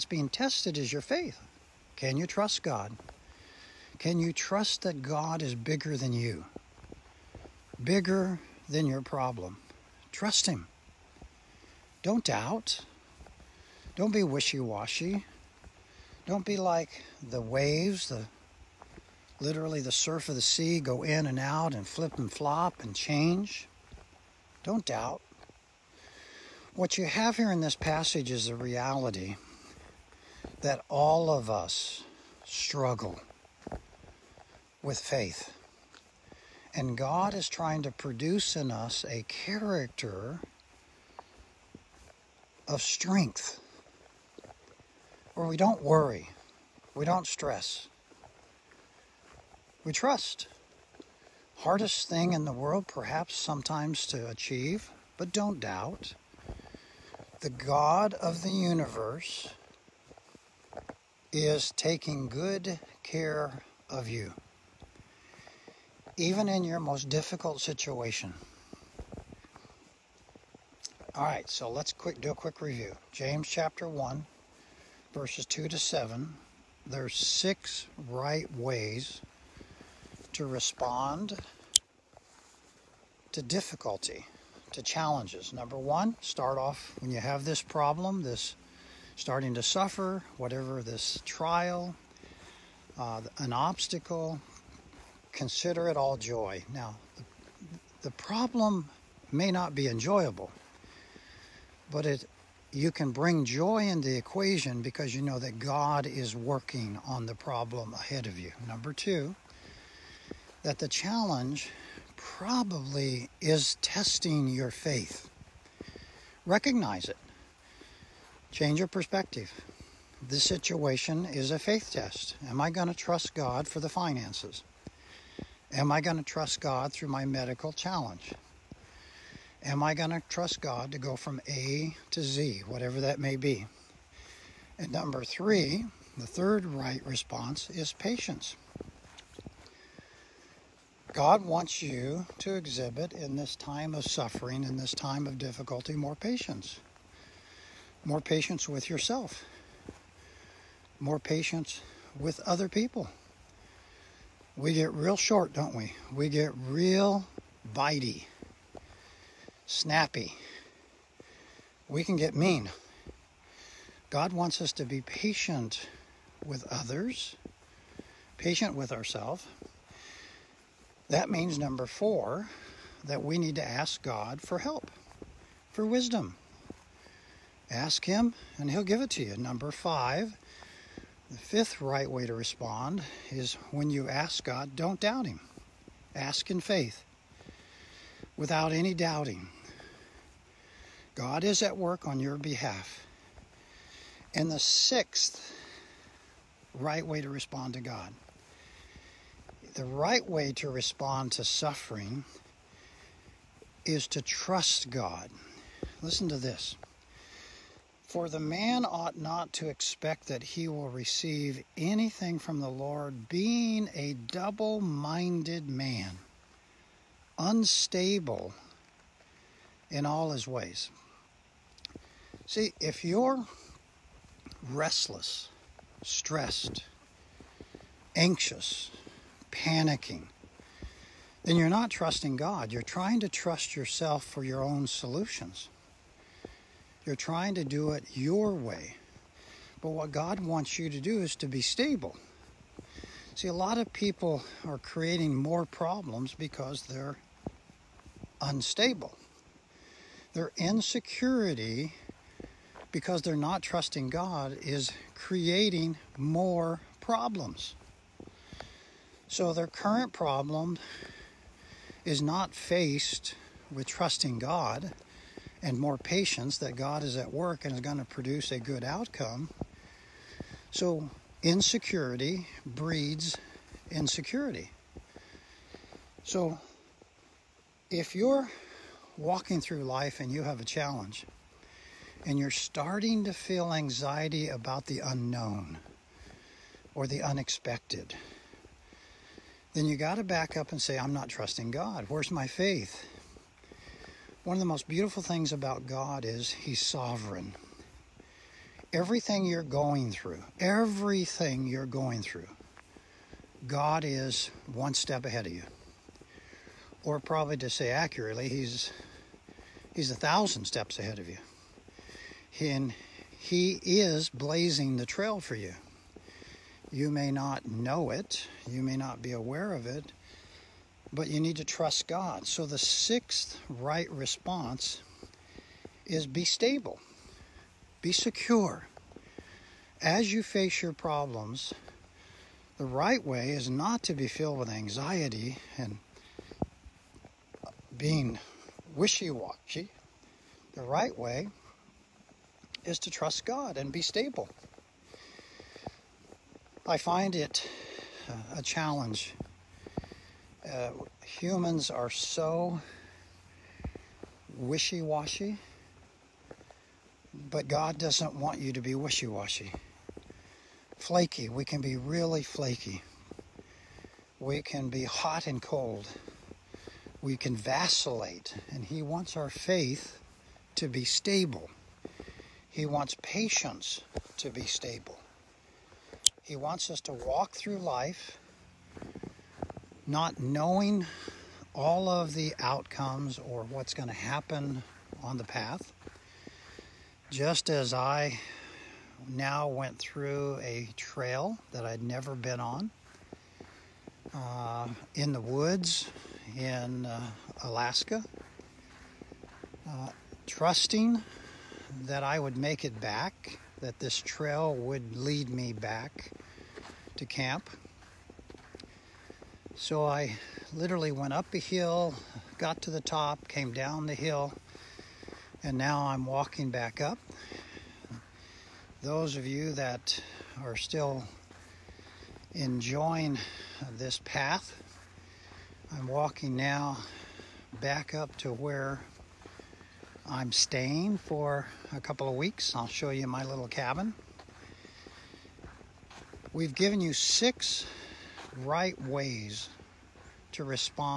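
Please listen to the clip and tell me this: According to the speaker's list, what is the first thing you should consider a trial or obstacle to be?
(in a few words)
all joy.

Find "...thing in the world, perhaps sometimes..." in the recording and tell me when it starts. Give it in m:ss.
0:52.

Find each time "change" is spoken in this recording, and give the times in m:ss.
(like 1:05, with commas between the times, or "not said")
0:22, 1:58.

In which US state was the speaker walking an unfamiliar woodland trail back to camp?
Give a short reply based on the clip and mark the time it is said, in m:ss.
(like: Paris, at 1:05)
Alaska, at 6:37.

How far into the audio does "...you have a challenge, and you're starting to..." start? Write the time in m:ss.
4:40.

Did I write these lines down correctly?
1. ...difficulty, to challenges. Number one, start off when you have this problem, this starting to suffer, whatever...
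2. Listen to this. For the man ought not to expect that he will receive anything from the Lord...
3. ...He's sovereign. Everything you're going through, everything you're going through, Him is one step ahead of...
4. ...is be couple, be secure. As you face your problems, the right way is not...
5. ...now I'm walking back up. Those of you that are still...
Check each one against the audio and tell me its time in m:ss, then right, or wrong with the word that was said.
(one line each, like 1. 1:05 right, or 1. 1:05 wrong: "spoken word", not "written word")
1. 1:23 right
2. 3:26 right
3. 4:56 wrong: "God", not "Him"
4. 5:26 wrong: "stable", not "couple"
5. 6:55 right.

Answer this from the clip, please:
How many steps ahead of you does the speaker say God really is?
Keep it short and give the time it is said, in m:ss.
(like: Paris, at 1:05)
1000, at 5:10.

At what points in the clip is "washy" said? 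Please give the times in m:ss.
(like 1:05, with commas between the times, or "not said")
0:14, 5:39, 5:55, 5:59.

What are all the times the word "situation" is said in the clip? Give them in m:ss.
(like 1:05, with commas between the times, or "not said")
1:07, 2:00.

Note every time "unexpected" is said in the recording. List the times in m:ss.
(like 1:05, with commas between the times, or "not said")
4:47.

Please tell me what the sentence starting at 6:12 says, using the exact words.
He wants patience to be stable.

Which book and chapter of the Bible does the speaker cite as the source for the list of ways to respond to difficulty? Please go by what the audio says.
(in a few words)
James chapter 1.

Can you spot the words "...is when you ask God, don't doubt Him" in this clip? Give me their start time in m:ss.
3:03.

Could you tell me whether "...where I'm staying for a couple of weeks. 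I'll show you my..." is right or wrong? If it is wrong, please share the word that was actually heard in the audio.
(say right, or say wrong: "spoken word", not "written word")
right.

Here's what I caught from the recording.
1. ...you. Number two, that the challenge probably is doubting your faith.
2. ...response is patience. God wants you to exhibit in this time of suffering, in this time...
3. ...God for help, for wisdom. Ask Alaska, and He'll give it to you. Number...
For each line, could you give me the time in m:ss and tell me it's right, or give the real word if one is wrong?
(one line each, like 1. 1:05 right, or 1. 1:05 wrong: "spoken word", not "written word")
1. 1:48 wrong: "testing", not "doubting"
2. 2:17 right
3. 2:54 wrong: "Him", not "Alaska".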